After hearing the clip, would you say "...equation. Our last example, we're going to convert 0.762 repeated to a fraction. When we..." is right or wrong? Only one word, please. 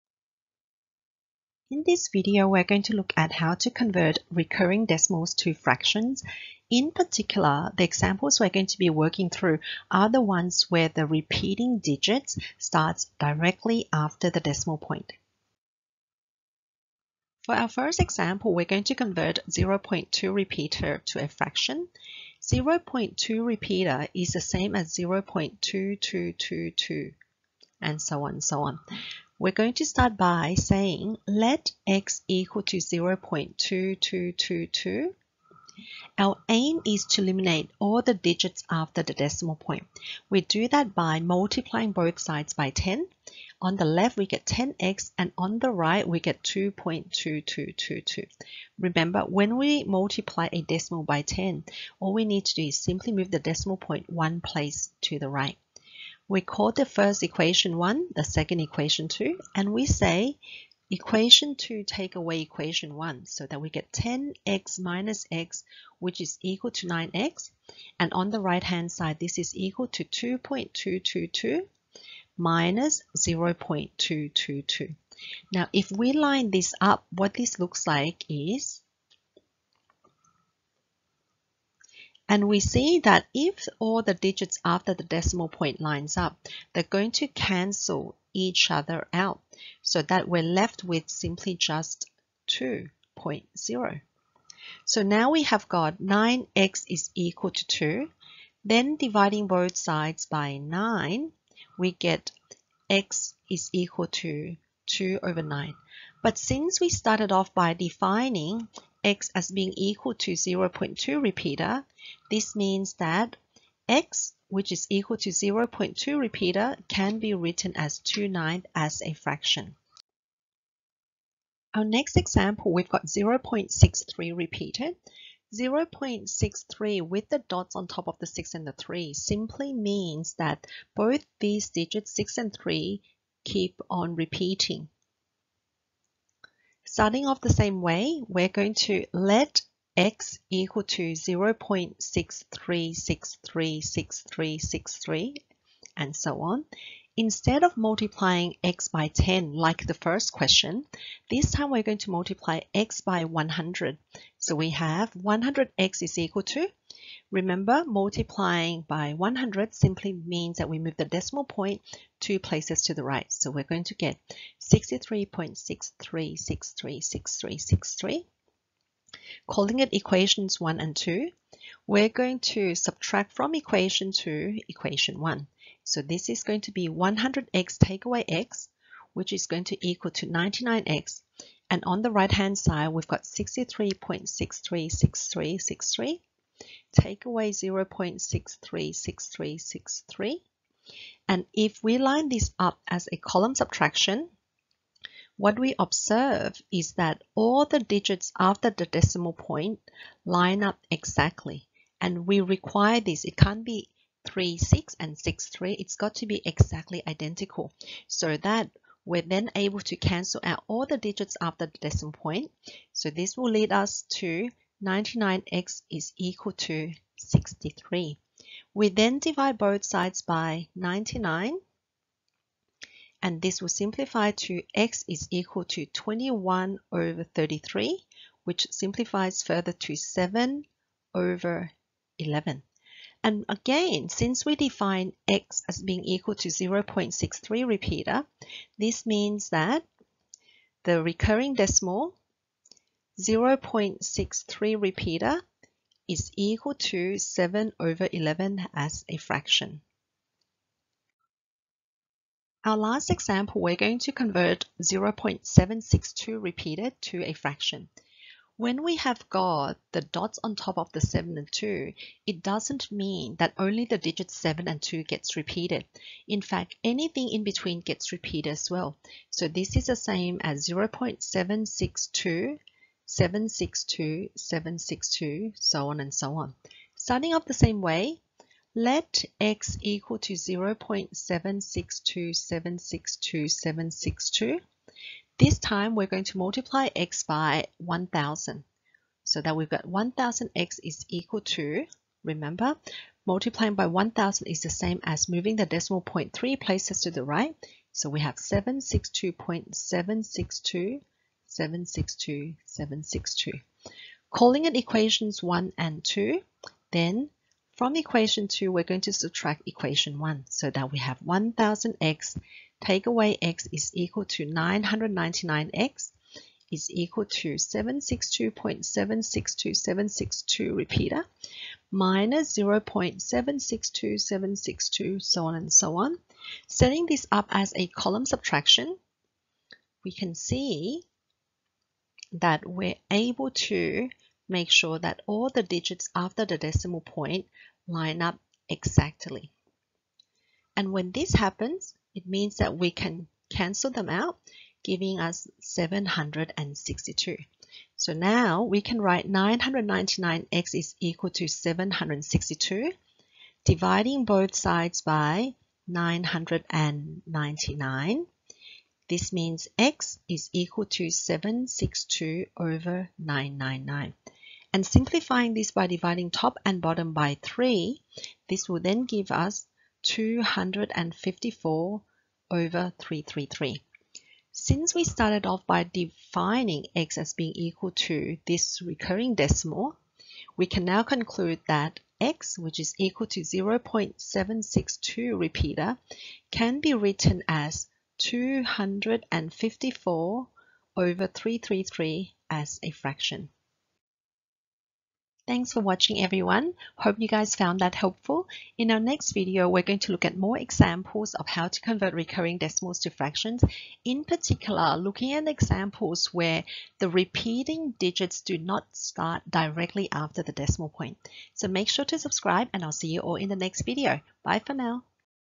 wrong.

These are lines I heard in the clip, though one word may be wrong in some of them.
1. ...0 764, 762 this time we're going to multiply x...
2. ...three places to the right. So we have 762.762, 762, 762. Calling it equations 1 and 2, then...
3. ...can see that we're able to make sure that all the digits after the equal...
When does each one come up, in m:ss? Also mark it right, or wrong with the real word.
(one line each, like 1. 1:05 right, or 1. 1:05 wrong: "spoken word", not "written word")
1. 4:40 wrong: "762", not "764"
2. 4:56 right
3. 5:30 wrong: "decimal", not "equal".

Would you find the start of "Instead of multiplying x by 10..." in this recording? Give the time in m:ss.
2:27.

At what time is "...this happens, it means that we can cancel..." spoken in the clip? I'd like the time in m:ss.
5:41.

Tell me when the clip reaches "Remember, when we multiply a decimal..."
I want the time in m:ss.
0:48.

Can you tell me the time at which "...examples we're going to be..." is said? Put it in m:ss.
0:07.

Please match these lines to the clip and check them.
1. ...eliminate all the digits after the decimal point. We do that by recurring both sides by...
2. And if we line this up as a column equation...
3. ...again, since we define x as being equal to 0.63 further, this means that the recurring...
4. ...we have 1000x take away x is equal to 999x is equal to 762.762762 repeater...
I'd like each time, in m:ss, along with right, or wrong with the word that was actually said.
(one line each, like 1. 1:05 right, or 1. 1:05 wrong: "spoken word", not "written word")
1. 0:37 wrong: "multiplying", not "recurring"
2. 3:11 wrong: "subtraction", not "equation"
3. 3:53 wrong: "repeater", not "further"
4. 5:10 right.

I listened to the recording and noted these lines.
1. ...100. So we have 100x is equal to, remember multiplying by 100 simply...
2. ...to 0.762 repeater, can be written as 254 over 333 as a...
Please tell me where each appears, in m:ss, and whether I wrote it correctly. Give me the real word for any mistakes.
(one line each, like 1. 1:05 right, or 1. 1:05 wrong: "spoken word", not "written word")
1. 2:33 right
2. 6:23 right.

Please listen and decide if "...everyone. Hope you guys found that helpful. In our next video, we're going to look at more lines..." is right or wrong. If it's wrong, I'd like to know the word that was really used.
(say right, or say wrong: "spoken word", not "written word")
wrong: "examples", not "lines".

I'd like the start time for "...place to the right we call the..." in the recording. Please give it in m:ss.
0:54.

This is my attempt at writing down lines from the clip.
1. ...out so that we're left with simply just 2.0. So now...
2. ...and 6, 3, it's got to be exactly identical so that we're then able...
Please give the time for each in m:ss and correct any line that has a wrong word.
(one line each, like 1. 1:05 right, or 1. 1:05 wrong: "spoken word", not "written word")
1. 1:29 right
2. 3:24 right.